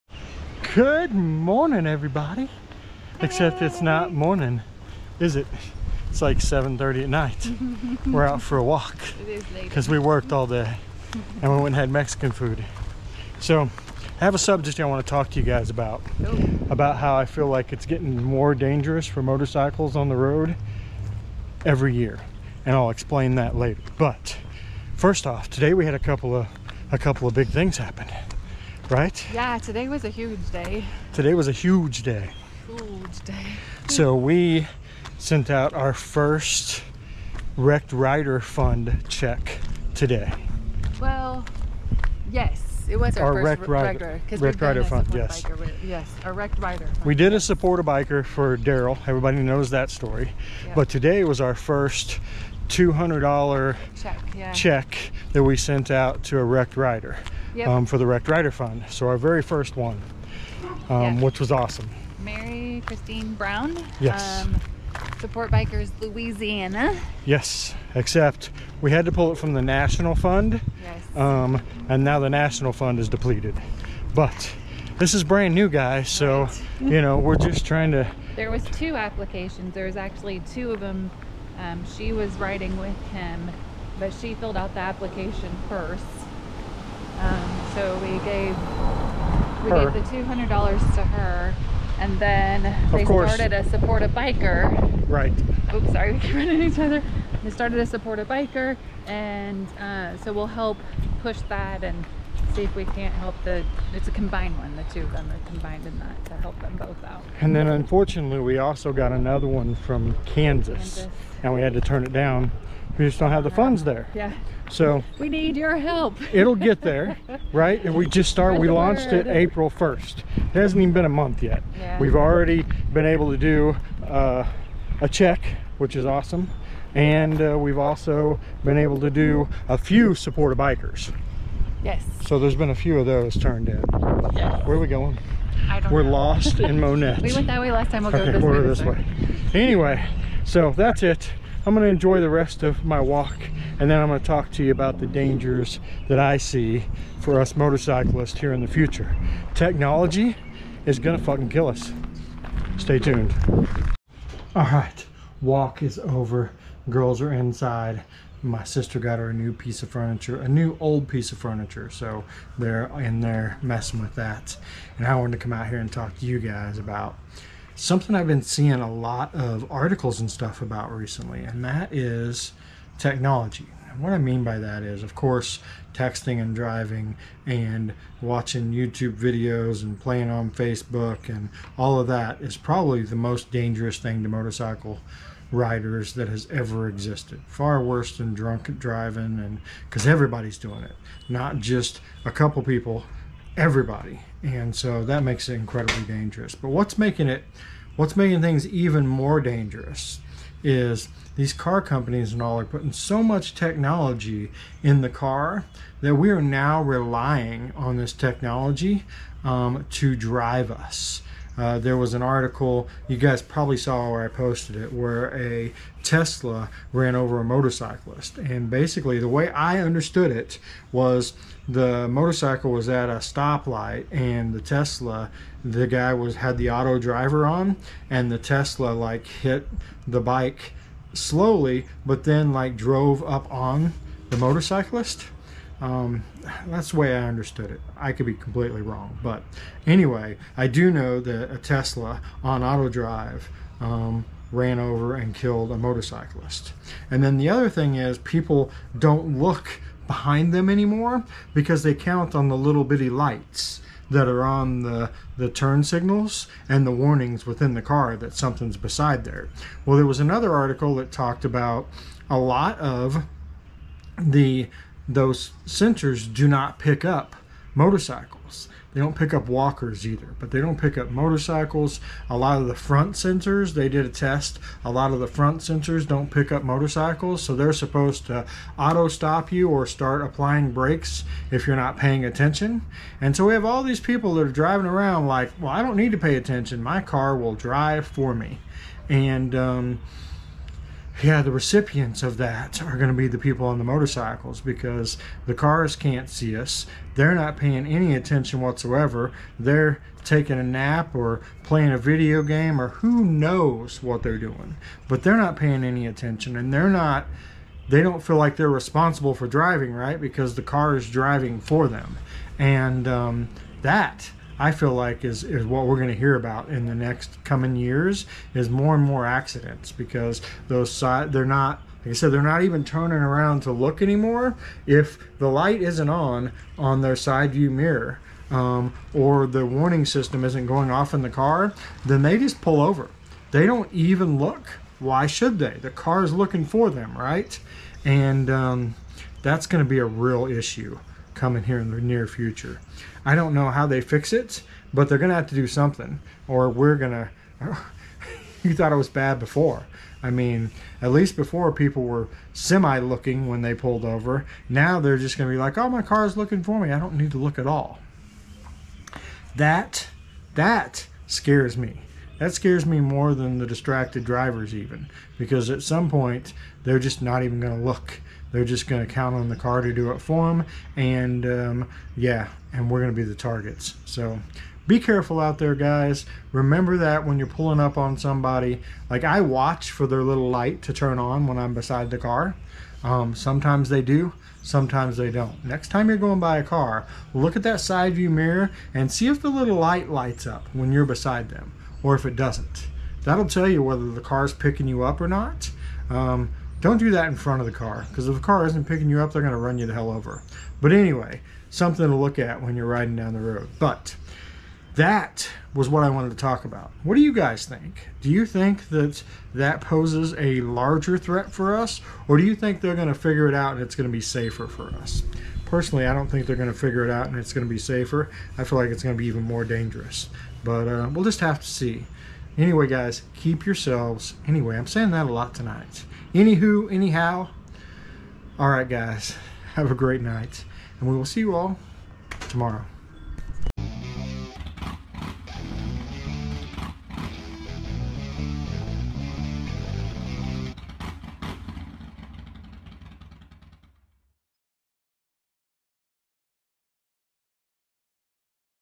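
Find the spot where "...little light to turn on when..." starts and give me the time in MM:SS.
06:20.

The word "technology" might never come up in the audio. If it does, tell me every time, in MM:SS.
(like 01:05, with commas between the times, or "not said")
02:29, 02:52, 03:23, 03:28.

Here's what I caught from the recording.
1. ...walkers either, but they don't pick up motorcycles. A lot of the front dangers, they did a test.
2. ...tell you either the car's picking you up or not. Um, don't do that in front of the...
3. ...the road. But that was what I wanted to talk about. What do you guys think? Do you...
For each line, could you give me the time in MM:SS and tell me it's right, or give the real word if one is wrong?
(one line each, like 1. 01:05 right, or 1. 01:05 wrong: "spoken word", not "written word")
1. 04:29 wrong: "sensors", not "dangers"
2. 06:33 wrong: "whether", not "either"
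3. 06:43 right.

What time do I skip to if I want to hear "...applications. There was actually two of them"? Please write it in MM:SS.
01:18.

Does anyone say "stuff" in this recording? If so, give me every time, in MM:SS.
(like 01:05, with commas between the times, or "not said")
02:50.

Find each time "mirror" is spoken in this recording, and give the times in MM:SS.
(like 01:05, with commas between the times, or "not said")
05:27, 06:28.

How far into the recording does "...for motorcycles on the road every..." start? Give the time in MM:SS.
00:19.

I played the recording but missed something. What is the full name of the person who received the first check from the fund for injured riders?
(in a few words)
Mary Christine Brown.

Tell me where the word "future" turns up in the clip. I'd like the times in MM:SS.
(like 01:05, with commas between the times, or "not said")
02:28, 05:42.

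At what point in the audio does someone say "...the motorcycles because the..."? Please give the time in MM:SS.
04:53.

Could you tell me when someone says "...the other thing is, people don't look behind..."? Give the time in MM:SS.
04:07.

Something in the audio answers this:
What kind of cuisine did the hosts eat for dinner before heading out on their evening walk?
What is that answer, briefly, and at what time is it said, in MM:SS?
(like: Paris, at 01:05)
Mexican, at 00:11.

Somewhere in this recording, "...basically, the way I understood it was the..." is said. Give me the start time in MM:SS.
03:38.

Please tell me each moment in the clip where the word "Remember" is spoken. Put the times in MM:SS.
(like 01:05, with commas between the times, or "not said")
06:16.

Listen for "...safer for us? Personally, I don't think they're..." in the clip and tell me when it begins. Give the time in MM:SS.
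06:54.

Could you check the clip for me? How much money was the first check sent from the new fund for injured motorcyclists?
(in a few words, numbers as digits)
$200.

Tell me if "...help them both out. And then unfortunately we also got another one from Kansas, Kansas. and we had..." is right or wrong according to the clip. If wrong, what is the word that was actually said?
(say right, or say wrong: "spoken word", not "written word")
right.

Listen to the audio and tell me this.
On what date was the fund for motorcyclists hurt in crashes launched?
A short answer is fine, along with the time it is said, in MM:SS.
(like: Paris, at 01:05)
April 1st, at 01:59.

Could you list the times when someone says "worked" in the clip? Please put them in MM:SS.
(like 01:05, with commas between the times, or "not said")
00:09.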